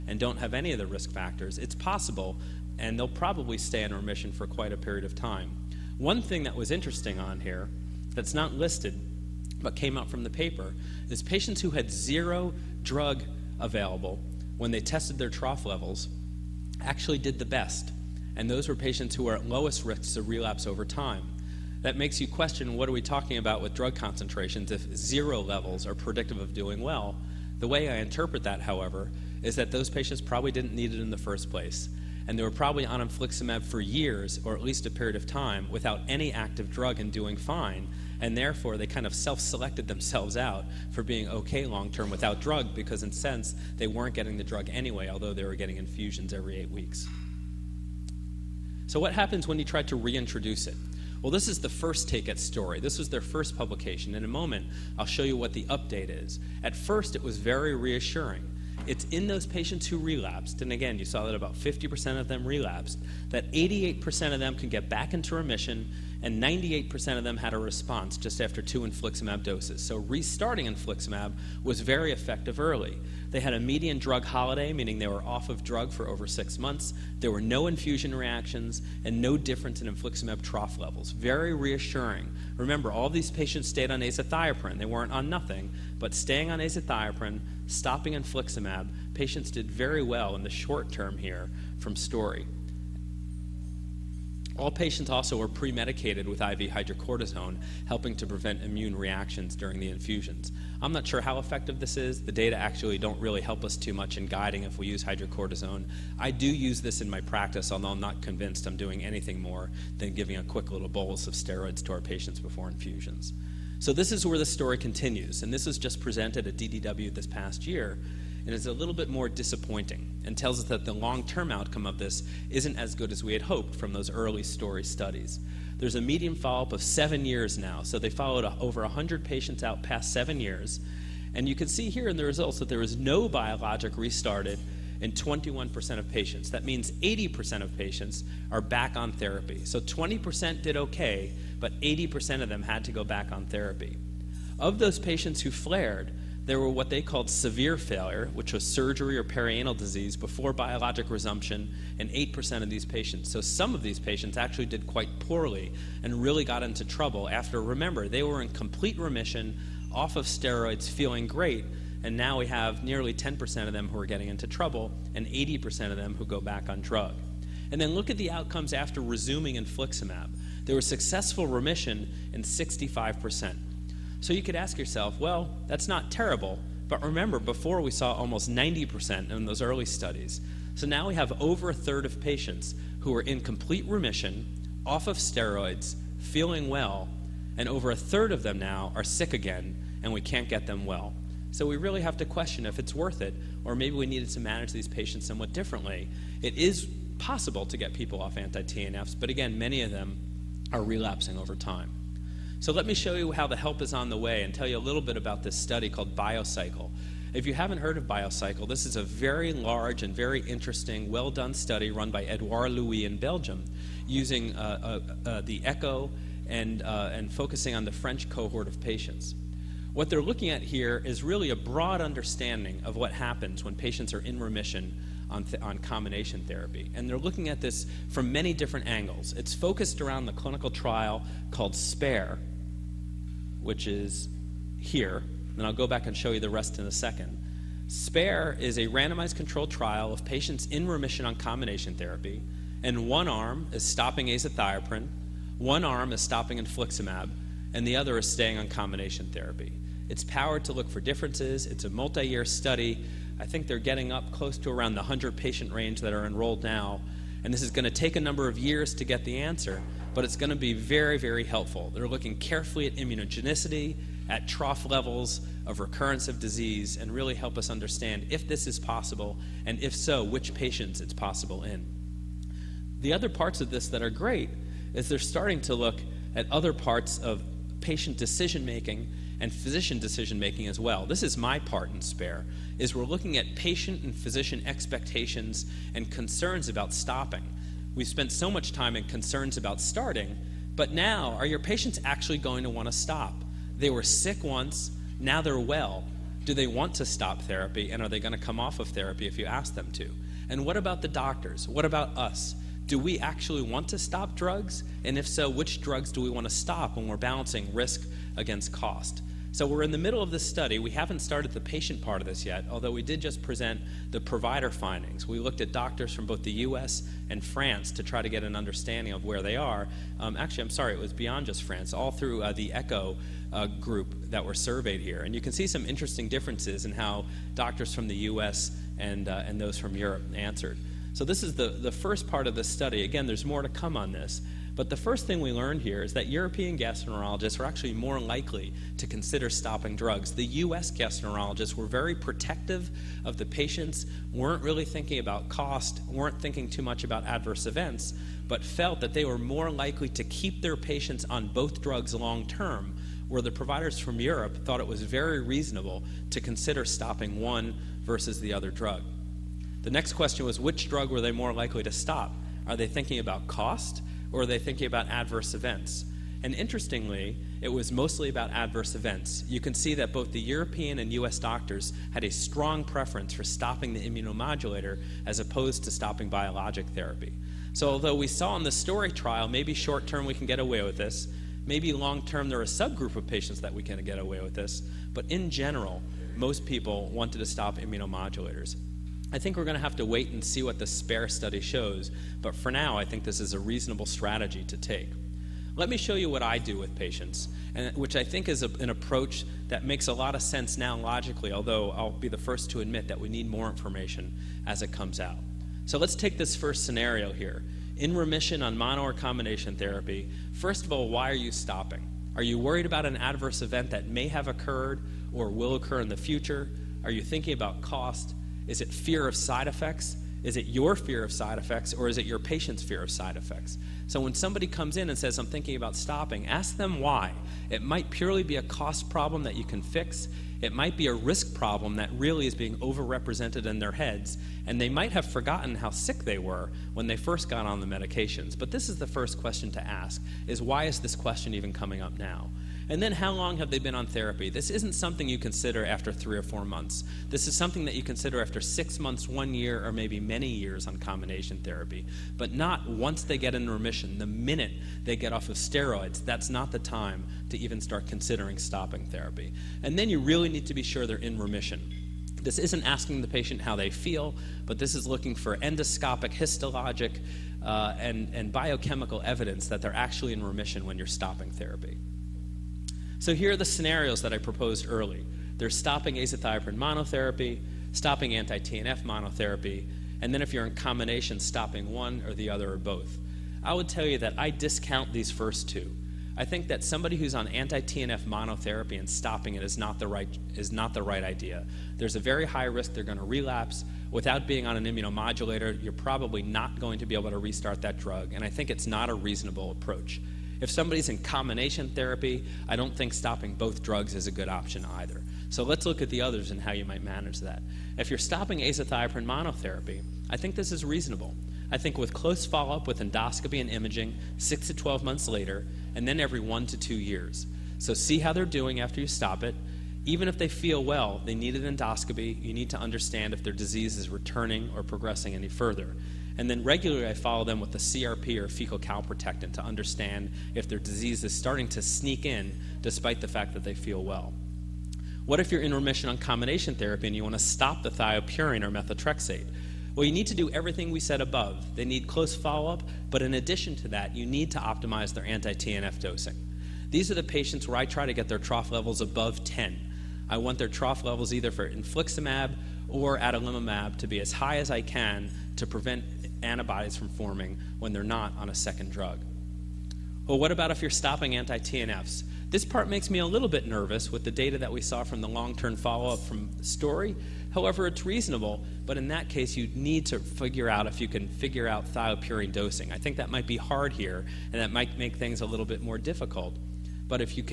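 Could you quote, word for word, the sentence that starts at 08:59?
Well, you need to do everything we said above.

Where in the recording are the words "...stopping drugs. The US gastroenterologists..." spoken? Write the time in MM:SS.
05:39.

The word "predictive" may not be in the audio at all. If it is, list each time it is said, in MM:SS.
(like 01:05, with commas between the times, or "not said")
00:25.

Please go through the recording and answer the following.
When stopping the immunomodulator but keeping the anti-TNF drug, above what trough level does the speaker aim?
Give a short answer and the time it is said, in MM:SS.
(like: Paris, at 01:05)
10, at 09:09.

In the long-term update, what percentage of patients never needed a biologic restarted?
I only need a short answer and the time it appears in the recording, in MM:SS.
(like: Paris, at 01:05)
21%, at 02:15.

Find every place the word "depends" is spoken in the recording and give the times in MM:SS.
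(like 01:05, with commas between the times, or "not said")
not said.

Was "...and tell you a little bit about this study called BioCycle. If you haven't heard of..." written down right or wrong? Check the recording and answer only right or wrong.
right.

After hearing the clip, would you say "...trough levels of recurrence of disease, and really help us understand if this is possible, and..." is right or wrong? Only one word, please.
right.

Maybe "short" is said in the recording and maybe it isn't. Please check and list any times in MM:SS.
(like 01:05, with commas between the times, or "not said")
01:30, 06:19.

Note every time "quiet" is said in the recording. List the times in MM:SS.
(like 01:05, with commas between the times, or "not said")
not said.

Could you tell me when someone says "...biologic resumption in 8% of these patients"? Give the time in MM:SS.
02:30.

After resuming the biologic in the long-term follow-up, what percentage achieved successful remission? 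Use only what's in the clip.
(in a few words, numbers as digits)
65%.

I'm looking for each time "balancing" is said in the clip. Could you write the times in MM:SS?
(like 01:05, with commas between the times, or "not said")
05:07.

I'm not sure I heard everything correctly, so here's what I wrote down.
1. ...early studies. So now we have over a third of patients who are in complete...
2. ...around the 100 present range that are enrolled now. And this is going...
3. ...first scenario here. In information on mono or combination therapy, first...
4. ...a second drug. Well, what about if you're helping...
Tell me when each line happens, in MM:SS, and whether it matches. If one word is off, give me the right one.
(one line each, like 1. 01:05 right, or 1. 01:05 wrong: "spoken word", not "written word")
1. 02:59 right
2. 04:14 wrong: "patient", not "present"
3. 06:46 wrong: "remission", not "information"
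4. 09:18 wrong: "stopping", not "helping".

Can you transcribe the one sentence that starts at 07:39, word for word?
And then you really need to be sure they're in remission.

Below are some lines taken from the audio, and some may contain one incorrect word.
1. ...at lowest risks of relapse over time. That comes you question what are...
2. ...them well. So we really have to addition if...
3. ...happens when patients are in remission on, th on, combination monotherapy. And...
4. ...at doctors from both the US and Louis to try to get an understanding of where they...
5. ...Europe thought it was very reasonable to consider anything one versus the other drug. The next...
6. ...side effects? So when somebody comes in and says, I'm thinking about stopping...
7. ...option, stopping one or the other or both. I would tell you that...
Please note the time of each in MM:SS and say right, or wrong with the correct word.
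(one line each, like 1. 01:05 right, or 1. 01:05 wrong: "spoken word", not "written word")
1. 00:19 wrong: "makes", not "comes"
2. 03:10 wrong: "question", not "addition"
3. 03:43 wrong: "therapy", not "monotherapy"
4. 05:15 wrong: "France", not "Louis"
5. 05:54 wrong: "stopping", not "anything"
6. 07:03 right
7. 08:00 wrong: "combination", not "option".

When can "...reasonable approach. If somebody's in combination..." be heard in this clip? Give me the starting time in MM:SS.
08:19.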